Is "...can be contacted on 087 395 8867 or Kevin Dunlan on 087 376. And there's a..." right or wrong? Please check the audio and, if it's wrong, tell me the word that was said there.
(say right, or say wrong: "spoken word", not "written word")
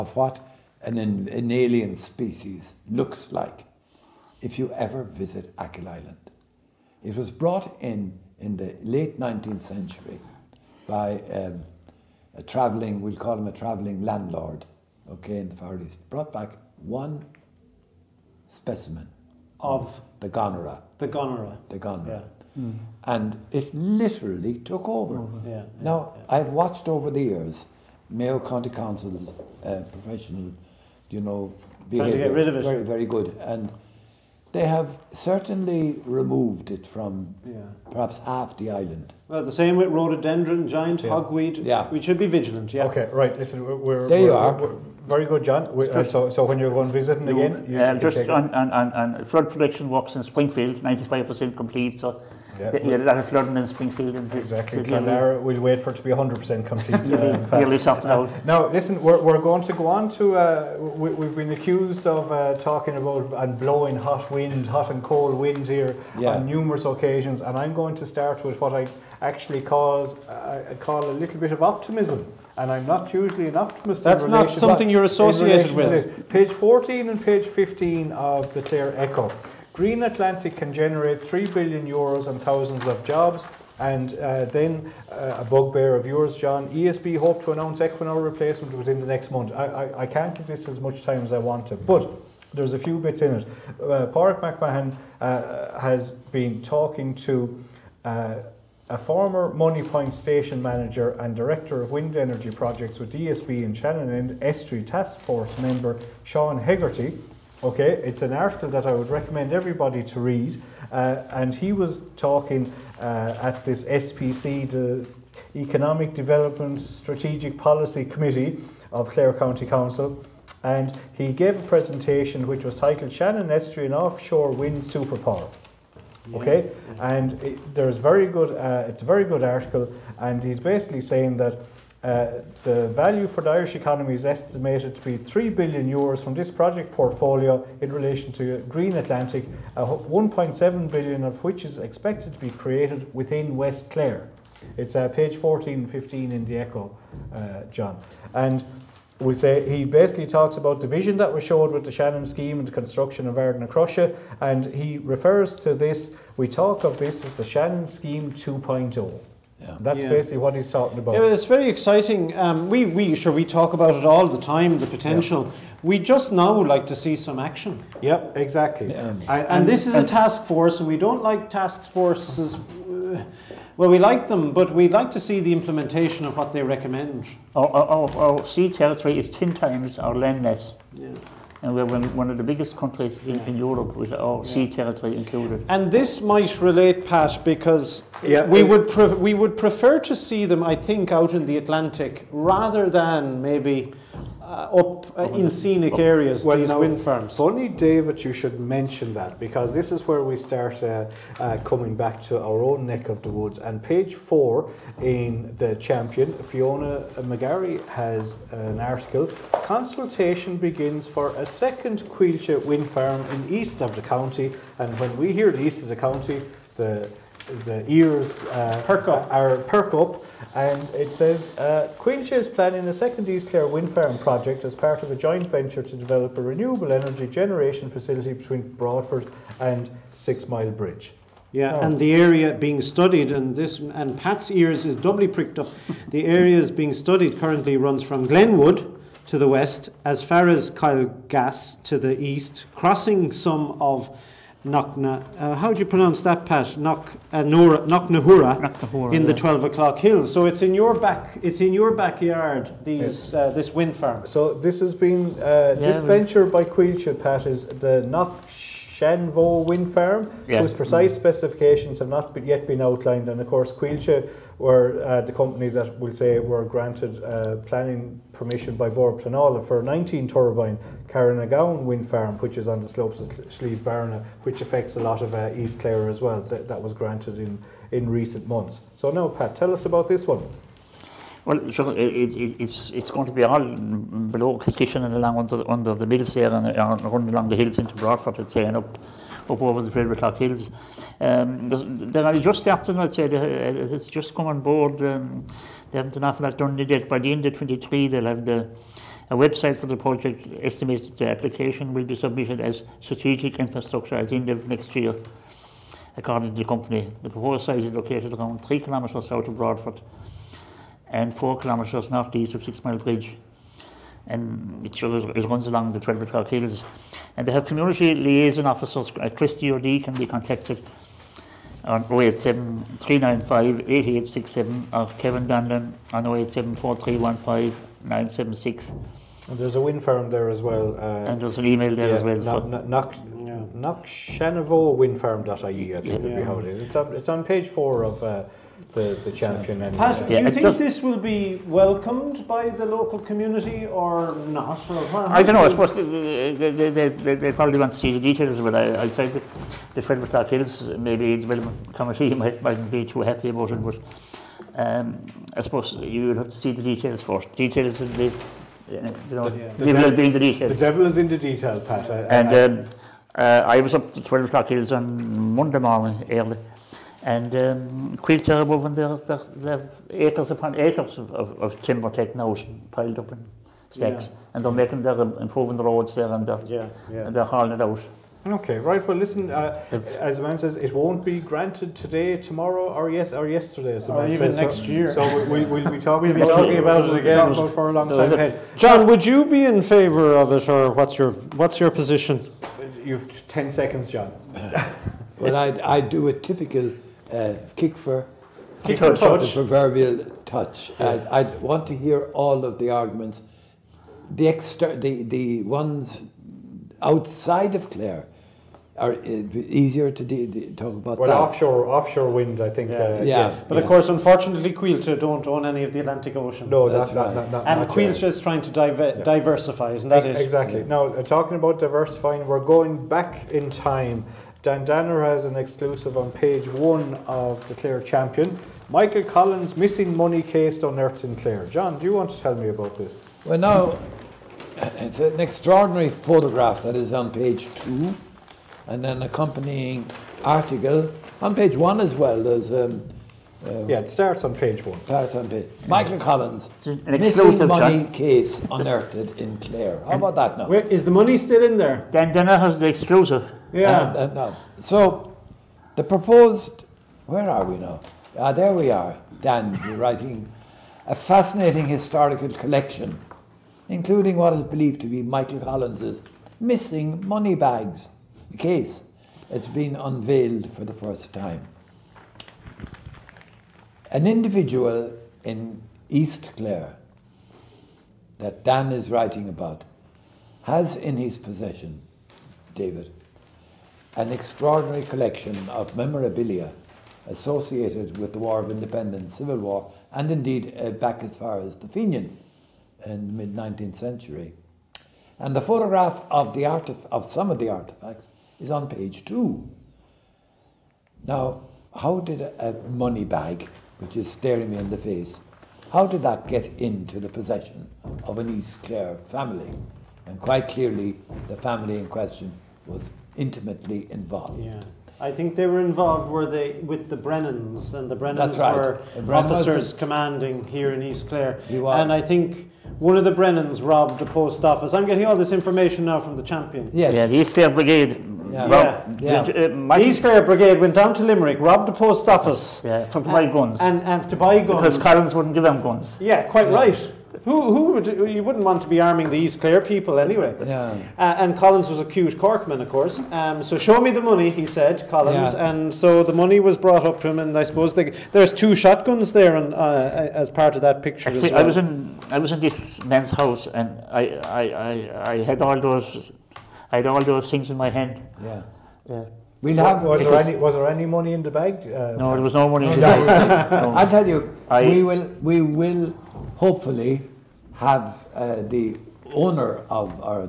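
wrong: "976", not "376".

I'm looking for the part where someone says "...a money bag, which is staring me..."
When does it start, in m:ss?
8:22.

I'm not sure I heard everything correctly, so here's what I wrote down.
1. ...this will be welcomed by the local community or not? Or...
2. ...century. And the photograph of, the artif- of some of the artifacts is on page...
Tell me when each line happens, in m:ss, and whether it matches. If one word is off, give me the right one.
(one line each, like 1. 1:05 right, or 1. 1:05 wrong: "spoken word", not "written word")
1. 5:40 right
2. 8:13 right.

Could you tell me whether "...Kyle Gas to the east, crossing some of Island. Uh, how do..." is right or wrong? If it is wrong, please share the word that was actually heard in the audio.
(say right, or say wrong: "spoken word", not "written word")
wrong: "Nakna", not "Island".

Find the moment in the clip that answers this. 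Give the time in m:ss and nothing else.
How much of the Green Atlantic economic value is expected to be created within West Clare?
2:19.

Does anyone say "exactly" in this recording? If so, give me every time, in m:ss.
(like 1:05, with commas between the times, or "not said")
0:54, 2:48, 7:00.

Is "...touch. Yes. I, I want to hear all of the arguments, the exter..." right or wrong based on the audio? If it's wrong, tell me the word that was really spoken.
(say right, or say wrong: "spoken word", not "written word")
right.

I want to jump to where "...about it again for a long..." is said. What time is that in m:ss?
6:26.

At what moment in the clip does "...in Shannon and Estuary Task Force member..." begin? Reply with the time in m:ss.
1:43.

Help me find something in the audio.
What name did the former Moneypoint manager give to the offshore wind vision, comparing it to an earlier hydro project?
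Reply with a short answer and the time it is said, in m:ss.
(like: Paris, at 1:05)
Shannon scheme 2.0, at 2:37.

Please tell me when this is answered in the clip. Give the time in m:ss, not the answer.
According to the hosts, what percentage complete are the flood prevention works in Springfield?
0:50.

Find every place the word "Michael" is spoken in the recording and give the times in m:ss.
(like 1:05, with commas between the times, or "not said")
7:08, 7:25, 7:45.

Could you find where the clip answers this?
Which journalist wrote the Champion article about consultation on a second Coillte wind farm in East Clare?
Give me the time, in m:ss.
3:26.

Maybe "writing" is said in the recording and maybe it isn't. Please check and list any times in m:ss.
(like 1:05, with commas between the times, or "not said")
7:39, 7:59.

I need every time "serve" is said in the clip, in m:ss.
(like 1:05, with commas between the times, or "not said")
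not said.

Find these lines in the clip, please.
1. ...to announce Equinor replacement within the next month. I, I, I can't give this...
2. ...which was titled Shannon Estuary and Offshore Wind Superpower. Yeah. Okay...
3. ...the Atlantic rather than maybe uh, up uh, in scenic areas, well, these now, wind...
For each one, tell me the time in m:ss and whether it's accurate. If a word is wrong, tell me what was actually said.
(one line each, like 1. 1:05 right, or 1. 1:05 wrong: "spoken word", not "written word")
1. 1:27 right
2. 2:02 right
3. 3:11 right.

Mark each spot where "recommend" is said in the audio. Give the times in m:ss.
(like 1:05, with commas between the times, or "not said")
1:49, 2:56.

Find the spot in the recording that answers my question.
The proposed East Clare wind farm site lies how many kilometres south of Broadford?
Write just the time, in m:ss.
5:08.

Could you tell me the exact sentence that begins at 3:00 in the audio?
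Yeah and we're one of the biggest countries in, in Europe with our sea territory included.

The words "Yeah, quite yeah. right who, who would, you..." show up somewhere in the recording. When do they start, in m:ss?
8:56.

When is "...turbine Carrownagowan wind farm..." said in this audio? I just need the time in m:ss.
4:30.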